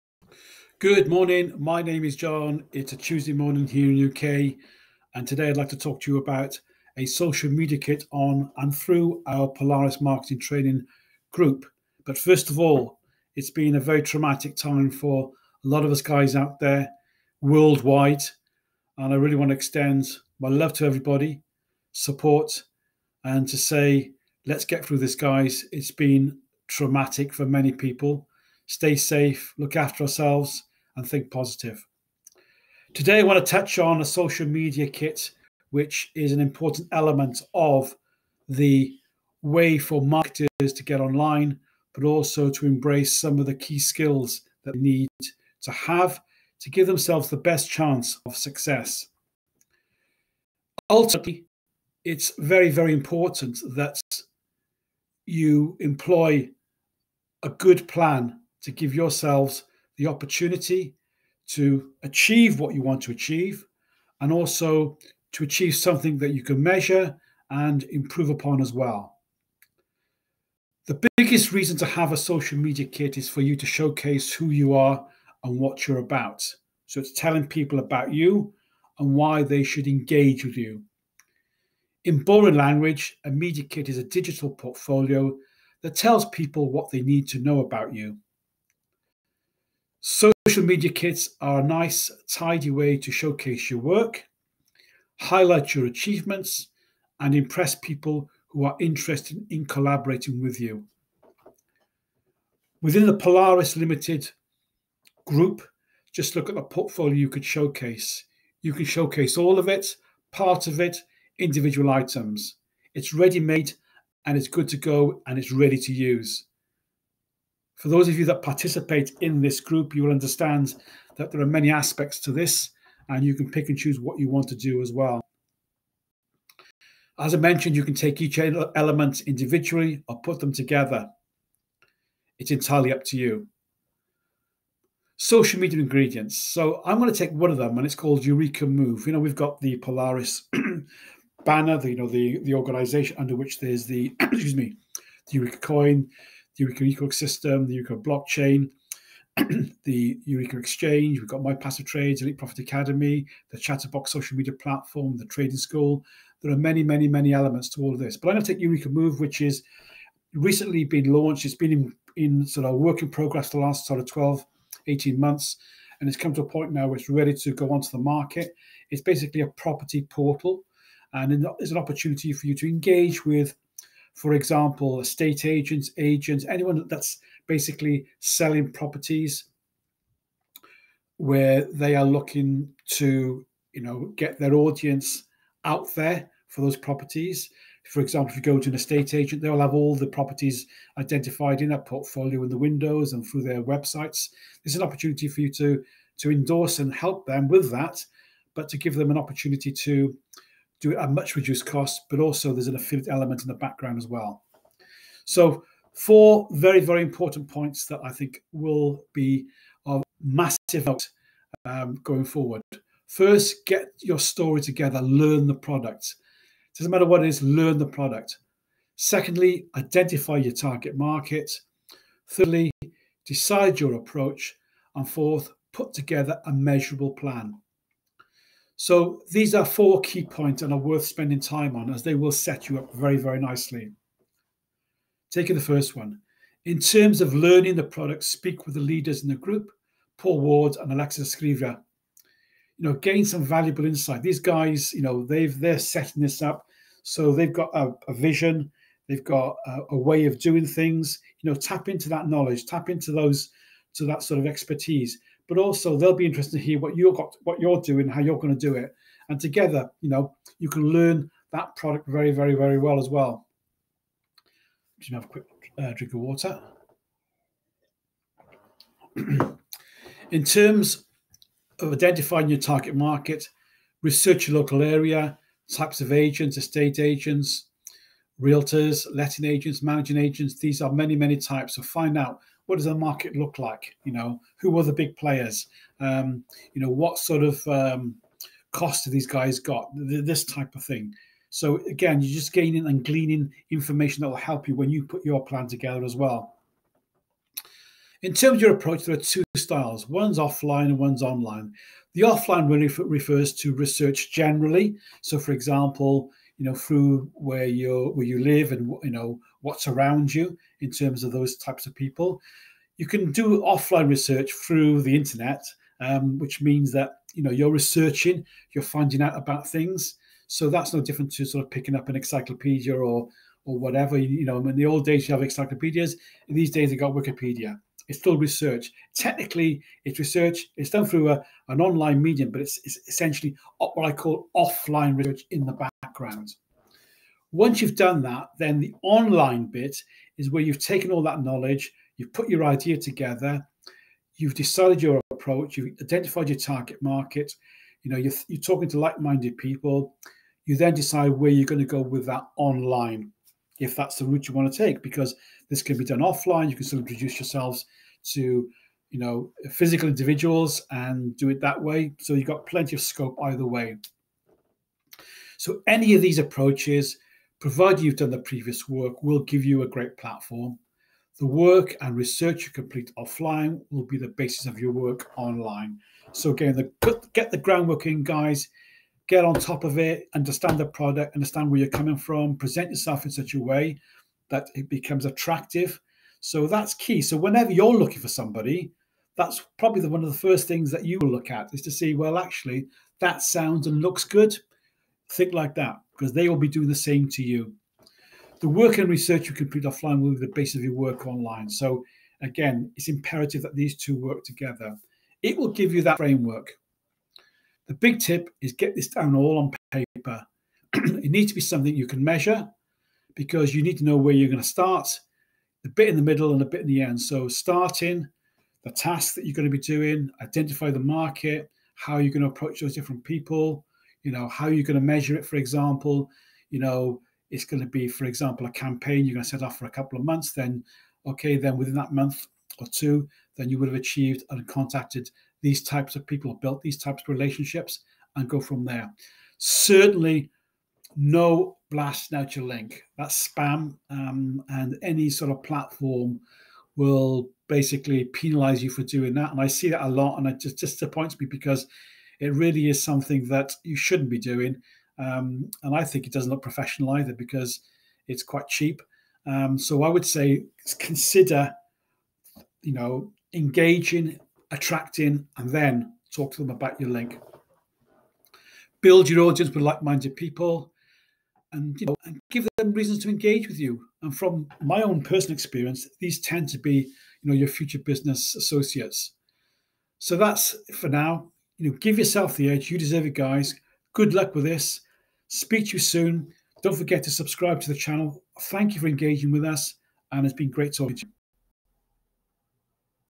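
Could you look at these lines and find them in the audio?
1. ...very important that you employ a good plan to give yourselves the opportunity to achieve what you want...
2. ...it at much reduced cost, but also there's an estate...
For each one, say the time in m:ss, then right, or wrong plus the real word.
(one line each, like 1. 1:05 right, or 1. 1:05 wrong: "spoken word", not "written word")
1. 0:52 right
2. 3:20 wrong: "affiliate", not "estate".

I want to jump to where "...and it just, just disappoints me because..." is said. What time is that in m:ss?
7:30.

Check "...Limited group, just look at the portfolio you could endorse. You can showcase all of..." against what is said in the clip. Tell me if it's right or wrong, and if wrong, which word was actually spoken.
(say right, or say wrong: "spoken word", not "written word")
wrong: "showcase", not "endorse".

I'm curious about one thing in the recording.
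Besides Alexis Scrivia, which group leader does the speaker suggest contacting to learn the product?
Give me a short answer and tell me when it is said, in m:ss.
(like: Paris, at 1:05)
Paul Ward, at 4:00.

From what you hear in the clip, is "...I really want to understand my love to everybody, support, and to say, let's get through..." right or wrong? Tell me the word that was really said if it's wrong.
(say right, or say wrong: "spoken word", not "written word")
wrong: "extend", not "understand".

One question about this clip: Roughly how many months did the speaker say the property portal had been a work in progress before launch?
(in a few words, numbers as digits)
12 to 18.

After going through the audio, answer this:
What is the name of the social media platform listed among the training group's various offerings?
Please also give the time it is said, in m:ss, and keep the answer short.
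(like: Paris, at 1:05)
Chatterbox, at 2:33.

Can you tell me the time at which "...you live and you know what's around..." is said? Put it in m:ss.
5:08.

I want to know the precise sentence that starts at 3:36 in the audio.
It doesn't matter what it is, learn the product.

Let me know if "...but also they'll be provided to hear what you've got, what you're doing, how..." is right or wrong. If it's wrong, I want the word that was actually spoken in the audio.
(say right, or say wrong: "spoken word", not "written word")
wrong: "interested", not "provided".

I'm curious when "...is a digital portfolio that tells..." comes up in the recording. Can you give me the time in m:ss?
1:23.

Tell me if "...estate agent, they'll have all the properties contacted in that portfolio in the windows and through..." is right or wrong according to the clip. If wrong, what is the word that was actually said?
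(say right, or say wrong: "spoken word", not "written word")
wrong: "identified", not "contacted".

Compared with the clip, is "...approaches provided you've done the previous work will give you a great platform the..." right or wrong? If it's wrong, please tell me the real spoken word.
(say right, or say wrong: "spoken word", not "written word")
right.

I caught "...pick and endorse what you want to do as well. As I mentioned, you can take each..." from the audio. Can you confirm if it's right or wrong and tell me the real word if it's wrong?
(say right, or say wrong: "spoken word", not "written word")
wrong: "choose", not "endorse".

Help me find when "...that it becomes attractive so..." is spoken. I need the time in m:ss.
6:24.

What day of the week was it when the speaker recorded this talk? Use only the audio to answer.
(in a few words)
Tuesday.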